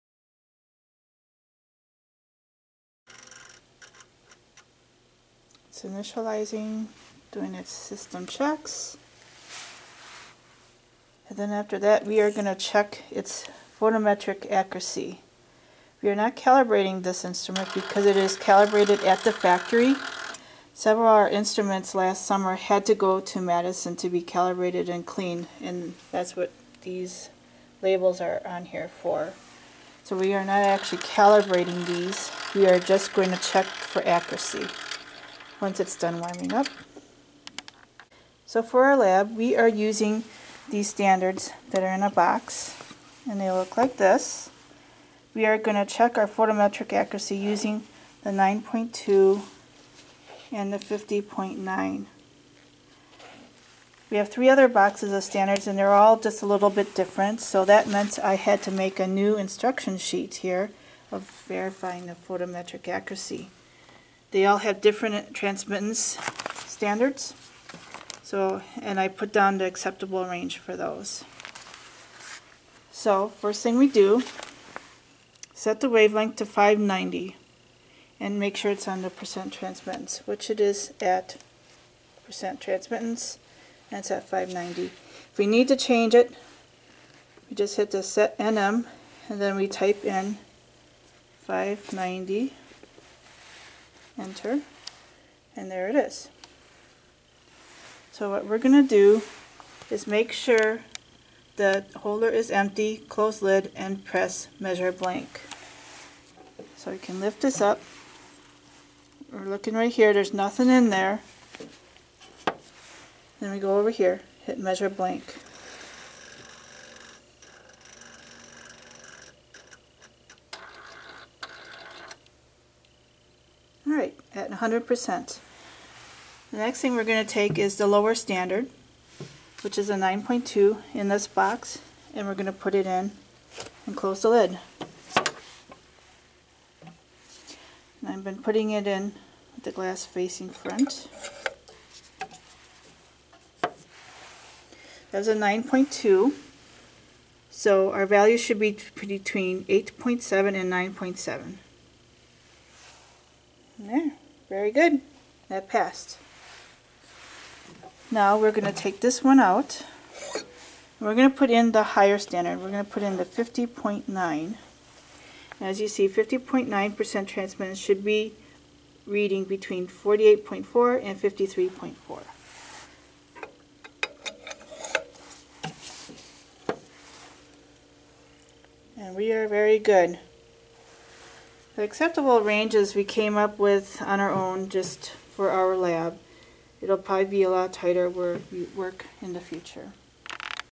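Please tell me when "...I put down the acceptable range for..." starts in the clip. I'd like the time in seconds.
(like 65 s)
68 s.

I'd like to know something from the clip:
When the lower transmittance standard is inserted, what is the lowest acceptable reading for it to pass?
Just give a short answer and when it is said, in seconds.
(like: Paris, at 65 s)
8.7, at 149 s.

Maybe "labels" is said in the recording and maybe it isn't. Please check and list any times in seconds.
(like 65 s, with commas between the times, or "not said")
27 s.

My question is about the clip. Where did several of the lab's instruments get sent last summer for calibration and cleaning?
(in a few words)
Madison.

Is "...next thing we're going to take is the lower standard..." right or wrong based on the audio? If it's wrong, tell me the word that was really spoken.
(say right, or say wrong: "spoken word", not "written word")
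right.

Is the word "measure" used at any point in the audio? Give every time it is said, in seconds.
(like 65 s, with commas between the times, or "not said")
104 s, 114 s.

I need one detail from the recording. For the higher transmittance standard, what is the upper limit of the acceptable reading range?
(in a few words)
53.4.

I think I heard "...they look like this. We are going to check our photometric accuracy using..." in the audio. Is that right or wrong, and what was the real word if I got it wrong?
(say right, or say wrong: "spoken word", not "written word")
right.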